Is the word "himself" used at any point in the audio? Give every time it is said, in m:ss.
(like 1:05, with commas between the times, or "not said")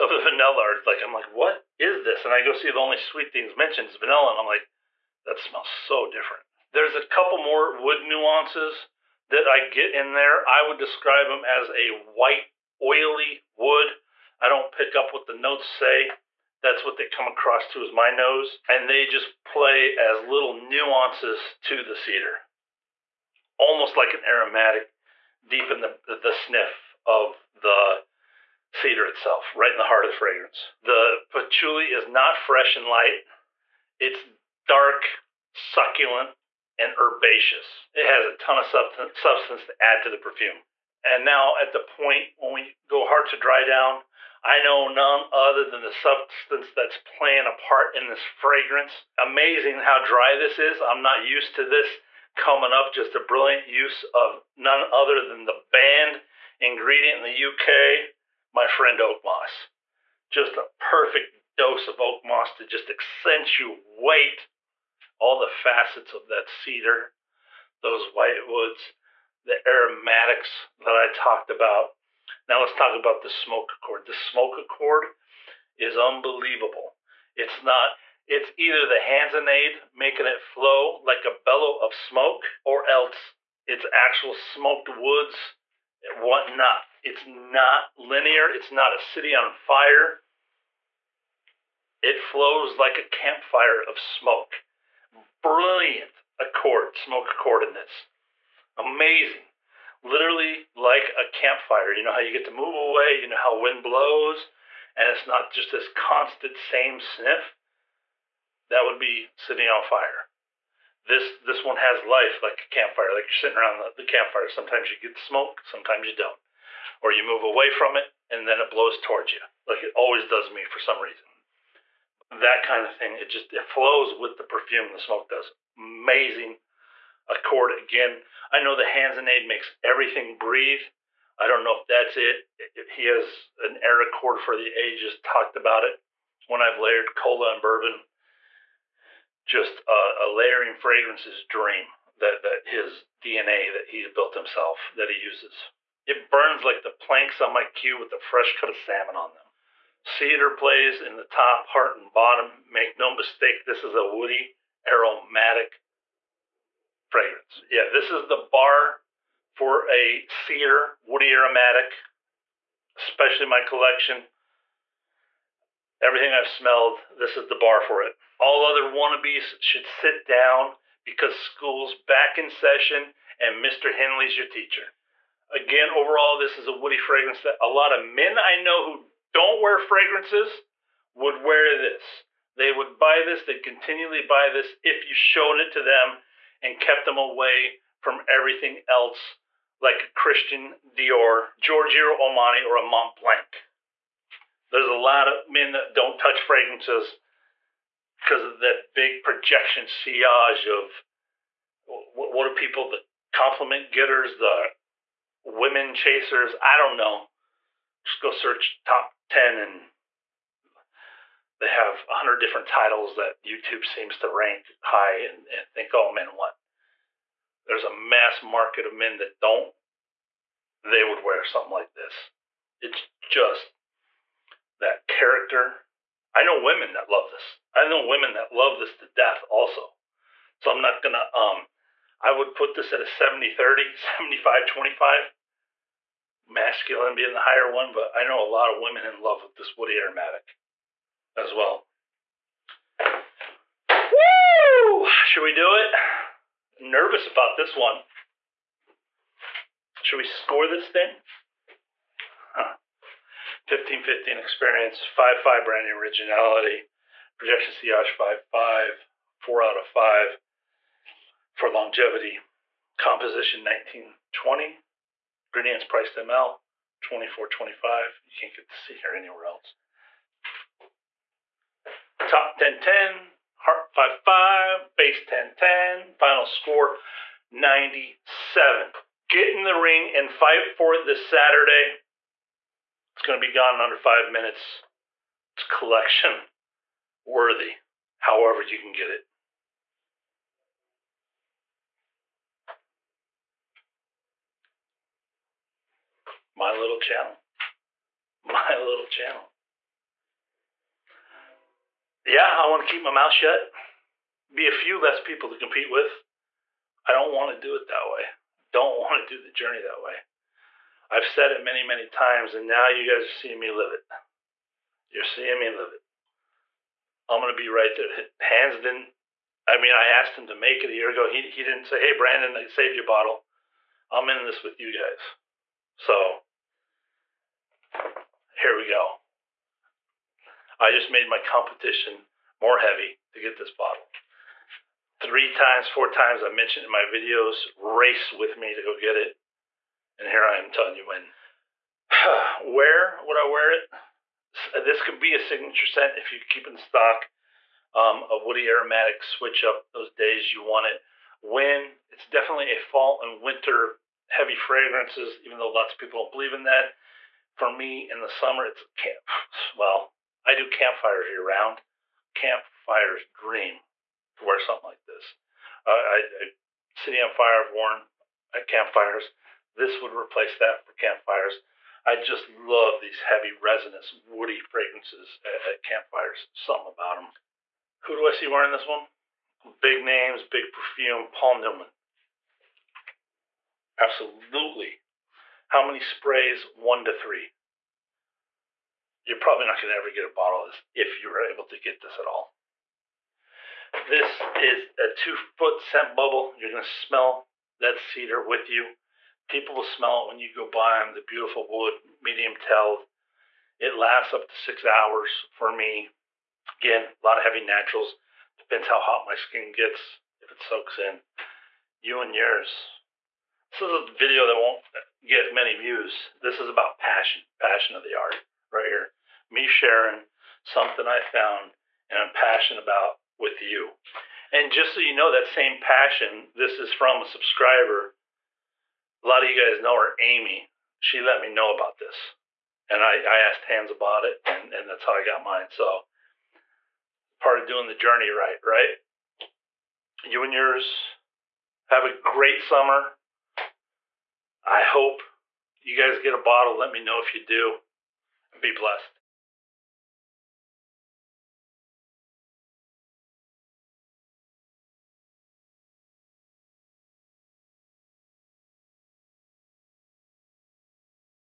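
2:24.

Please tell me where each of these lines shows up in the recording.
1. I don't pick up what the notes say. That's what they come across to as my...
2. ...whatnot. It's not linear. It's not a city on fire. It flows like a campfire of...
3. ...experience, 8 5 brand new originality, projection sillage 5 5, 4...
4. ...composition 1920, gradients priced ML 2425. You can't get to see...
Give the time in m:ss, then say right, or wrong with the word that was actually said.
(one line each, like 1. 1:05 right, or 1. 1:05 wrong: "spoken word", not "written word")
1. 0:14 right
2. 1:26 right
3. 4:14 wrong: "5", not "8"
4. 4:22 right.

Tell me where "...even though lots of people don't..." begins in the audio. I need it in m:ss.
5:55.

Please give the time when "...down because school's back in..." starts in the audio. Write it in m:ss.
2:50.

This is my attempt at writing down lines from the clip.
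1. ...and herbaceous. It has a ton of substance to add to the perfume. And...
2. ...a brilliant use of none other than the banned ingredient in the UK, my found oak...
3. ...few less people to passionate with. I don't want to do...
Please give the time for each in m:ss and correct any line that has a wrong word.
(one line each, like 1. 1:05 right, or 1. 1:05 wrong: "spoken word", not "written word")
1. 0:36 right
2. 0:53 wrong: "friend", not "found"
3. 5:04 wrong: "compete", not "passionate".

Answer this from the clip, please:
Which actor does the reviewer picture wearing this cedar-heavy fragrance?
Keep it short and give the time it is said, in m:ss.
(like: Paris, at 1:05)
Paul Newman, at 6:21.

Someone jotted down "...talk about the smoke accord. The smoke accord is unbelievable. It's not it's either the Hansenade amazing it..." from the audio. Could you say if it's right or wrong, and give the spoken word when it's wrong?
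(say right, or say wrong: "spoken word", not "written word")
wrong: "making", not "amazing".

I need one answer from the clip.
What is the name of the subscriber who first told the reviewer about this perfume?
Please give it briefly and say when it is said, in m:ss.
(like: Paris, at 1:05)
Amy, at 7:10.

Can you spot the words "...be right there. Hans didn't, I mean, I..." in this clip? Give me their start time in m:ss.
5:17.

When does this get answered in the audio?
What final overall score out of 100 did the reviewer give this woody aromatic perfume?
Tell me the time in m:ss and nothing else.
4:37.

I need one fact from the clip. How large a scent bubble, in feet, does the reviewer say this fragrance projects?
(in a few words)
2 feet.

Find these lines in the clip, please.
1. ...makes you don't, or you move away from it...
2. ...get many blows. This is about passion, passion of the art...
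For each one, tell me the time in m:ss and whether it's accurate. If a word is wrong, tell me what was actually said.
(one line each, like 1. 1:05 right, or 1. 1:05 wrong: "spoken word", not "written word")
1. 1:55 wrong: "sometimes", not "makes"
2. 6:55 wrong: "views", not "blows".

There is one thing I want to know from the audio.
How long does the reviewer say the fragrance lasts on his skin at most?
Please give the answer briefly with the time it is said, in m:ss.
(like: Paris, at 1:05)
6 hours, at 6:44.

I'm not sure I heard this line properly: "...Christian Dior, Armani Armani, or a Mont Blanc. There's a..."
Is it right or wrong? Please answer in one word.
wrong.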